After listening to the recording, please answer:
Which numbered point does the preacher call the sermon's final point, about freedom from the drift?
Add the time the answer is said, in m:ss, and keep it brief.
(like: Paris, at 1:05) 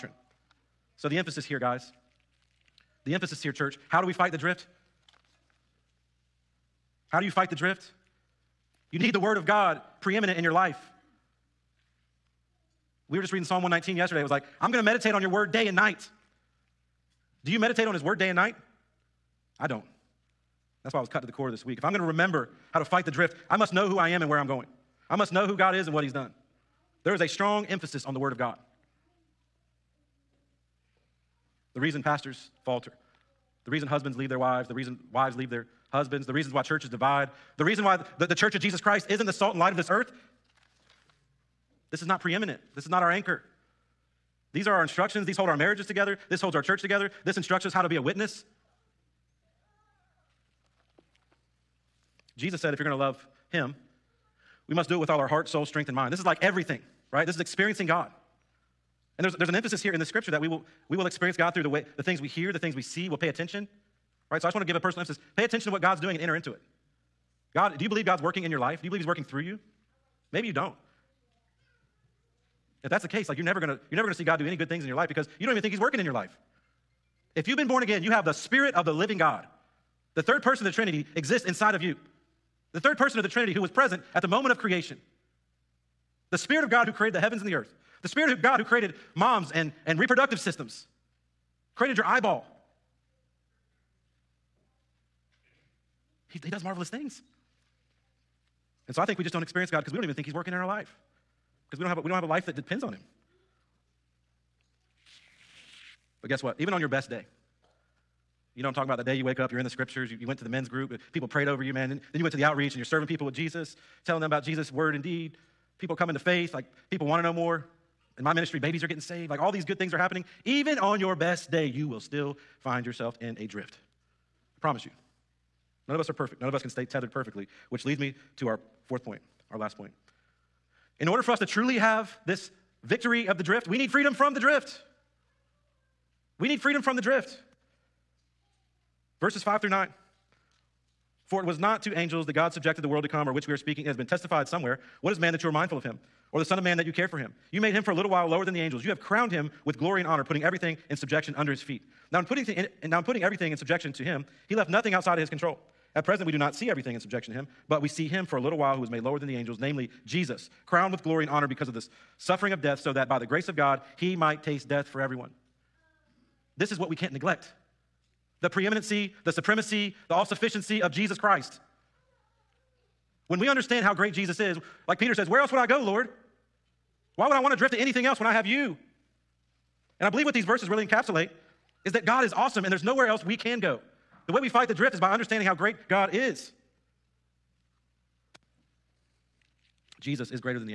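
Fourth, at 2:08.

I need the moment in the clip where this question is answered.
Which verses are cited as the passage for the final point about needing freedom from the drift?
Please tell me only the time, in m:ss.
2:19.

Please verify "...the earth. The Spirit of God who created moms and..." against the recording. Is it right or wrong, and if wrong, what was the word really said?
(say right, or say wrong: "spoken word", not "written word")
right.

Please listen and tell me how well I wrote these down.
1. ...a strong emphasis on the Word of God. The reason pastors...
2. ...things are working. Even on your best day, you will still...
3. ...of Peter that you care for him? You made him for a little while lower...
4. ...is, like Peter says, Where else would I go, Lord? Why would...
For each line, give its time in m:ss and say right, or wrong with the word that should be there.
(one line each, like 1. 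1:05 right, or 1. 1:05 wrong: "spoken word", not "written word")
1. 0:27 right
2. 1:59 wrong: "happening", not "working"
3. 2:26 wrong: "Man", not "Peter"
4. 2:54 right.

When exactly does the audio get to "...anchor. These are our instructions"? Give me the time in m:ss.
0:43.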